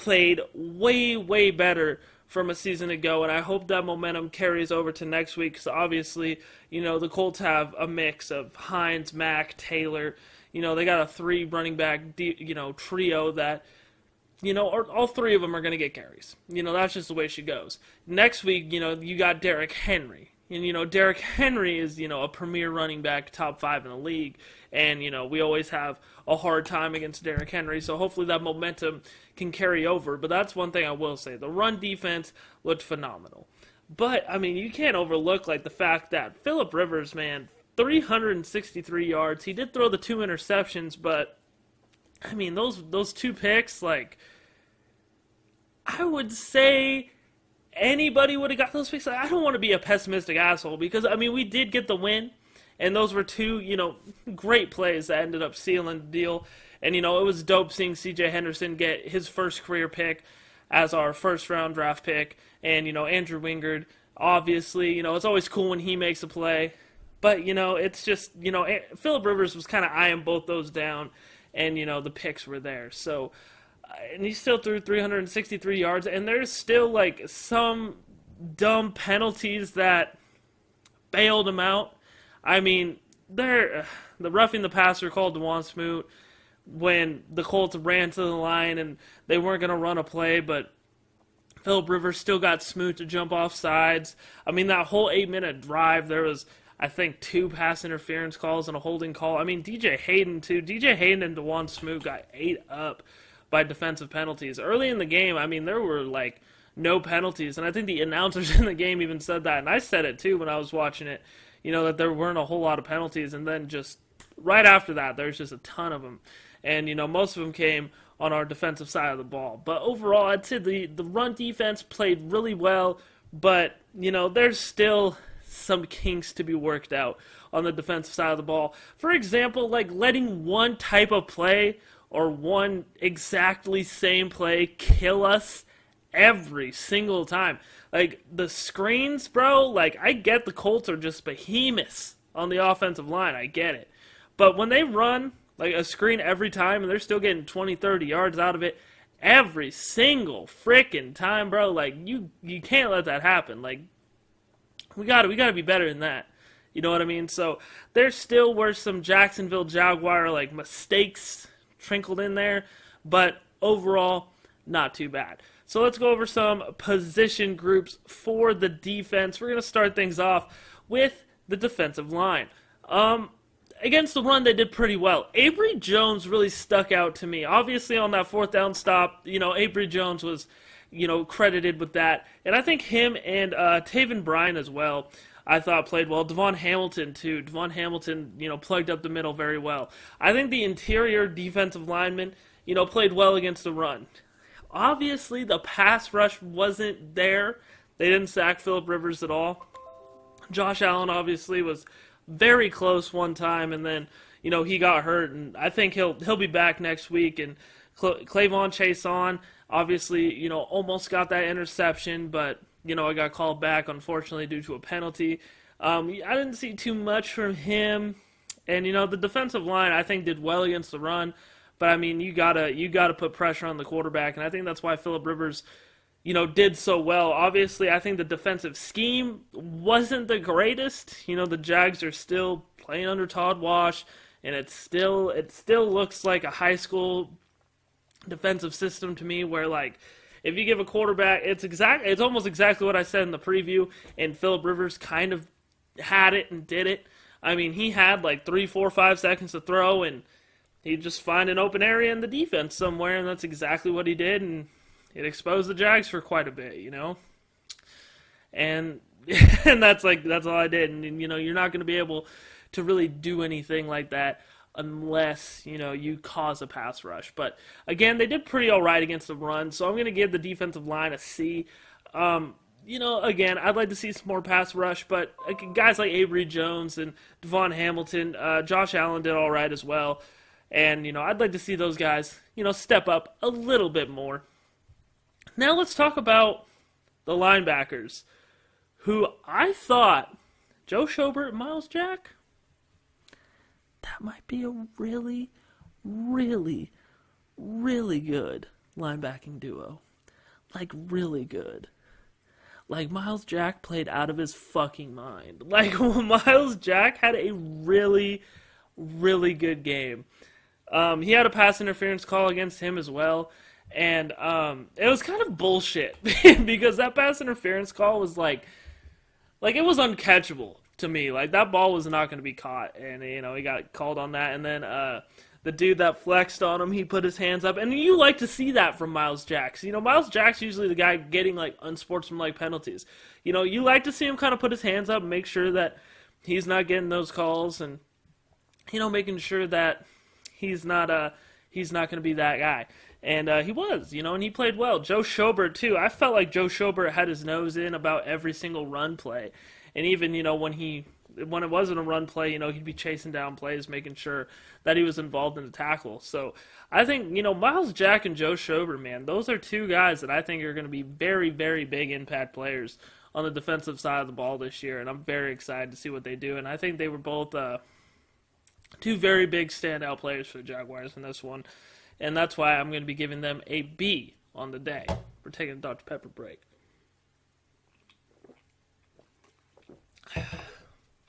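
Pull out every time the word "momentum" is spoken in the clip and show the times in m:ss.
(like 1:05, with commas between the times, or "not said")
0:03, 0:28.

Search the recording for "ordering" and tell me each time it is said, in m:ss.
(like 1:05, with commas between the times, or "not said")
not said.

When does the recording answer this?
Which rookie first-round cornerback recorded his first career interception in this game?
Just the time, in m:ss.
0:57.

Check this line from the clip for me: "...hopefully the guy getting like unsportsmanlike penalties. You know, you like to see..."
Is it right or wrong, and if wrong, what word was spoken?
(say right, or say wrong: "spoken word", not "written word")
wrong: "usually", not "hopefully".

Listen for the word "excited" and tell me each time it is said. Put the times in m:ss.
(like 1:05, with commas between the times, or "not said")
6:05.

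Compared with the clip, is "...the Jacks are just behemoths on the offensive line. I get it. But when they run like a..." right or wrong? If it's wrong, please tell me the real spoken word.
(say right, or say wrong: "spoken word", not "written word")
wrong: "Colts", not "Jacks".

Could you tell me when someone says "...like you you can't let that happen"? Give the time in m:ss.
2:31.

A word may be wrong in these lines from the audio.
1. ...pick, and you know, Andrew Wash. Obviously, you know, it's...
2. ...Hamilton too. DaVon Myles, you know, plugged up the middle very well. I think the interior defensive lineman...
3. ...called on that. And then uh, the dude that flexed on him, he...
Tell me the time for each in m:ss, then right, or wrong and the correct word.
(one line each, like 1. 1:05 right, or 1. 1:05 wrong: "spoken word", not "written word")
1. 1:02 wrong: "Wingard", not "Wash"
2. 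3:06 wrong: "Hamilton", not "Myles"
3. 5:23 right.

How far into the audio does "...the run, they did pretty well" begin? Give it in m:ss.
2:54.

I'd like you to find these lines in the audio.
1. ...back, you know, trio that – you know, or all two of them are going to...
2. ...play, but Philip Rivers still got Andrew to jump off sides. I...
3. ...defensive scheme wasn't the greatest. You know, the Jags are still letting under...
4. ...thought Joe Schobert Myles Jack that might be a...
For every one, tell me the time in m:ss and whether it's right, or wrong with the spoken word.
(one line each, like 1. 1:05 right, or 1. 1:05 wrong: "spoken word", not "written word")
1. 0:11 wrong: "three", not "two"
2. 1:30 wrong: "Smoot", not "Andrew"
3. 3:48 wrong: "playing", not "letting"
4. 4:49 right.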